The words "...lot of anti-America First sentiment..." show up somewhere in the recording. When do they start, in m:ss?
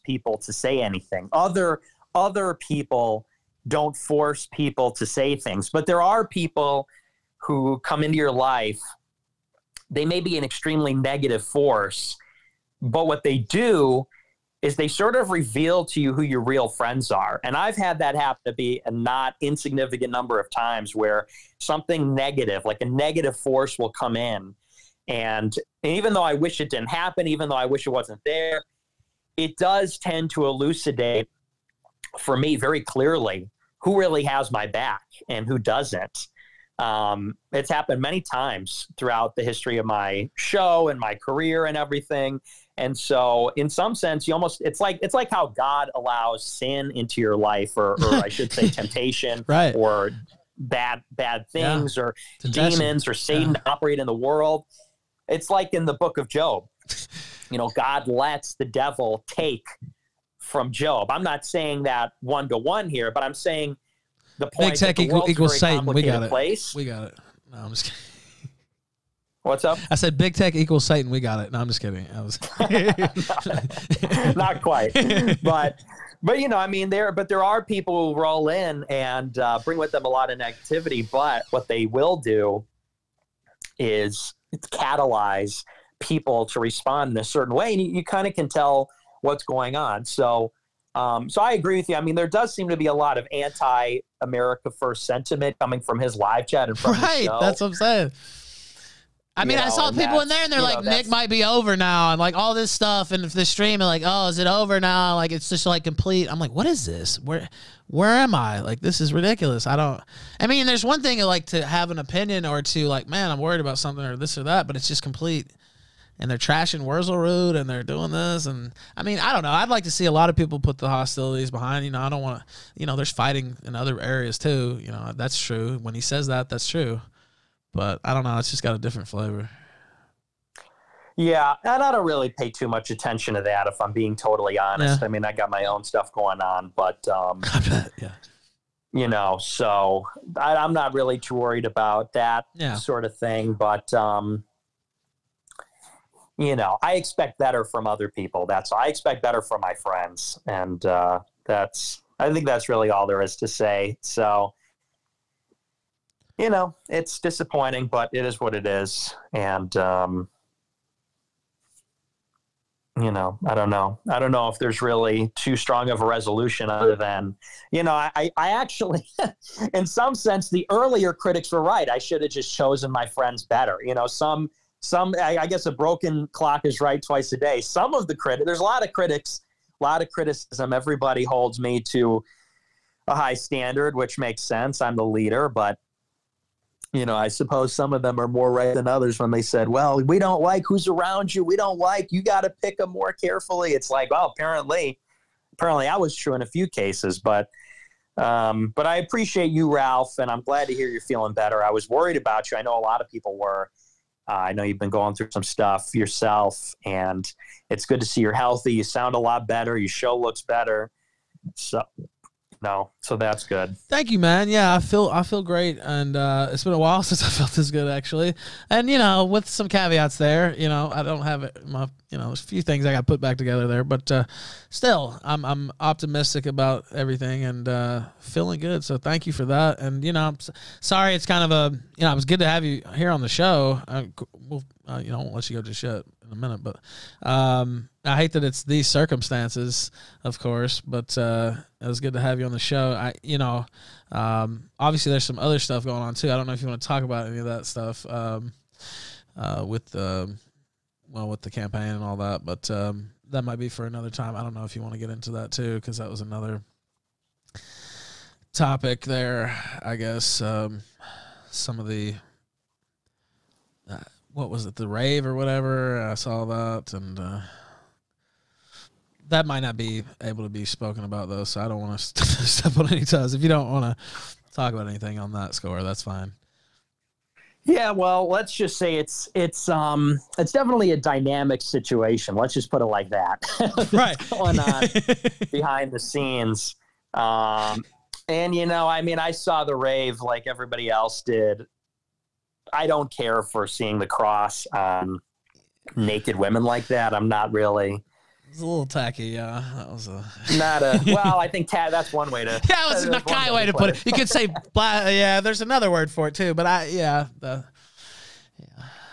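1:32.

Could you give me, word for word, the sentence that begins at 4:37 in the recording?
Yeah, well, let's just say it's it's um it's definitely a dynamic situation.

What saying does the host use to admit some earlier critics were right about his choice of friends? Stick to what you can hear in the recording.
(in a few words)
A broken clock.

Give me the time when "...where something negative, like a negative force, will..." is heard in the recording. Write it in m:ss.
0:20.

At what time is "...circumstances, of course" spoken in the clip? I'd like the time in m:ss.
3:58.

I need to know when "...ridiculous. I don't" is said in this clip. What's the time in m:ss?
1:49.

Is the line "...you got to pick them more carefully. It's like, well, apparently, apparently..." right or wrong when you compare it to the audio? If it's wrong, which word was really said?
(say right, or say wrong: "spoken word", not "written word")
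right.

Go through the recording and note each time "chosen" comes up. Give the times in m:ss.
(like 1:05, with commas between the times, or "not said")
2:52.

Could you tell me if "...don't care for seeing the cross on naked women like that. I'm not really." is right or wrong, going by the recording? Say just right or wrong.
right.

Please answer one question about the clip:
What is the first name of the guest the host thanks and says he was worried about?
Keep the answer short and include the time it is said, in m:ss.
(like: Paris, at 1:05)
Ralph, at 3:19.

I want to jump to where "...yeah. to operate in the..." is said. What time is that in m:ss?
0:53.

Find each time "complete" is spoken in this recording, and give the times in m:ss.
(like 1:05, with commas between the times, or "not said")
1:45, 1:55.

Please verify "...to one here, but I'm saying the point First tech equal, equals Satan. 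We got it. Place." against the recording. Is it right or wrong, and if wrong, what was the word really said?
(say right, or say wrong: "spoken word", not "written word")
wrong: "Big", not "First".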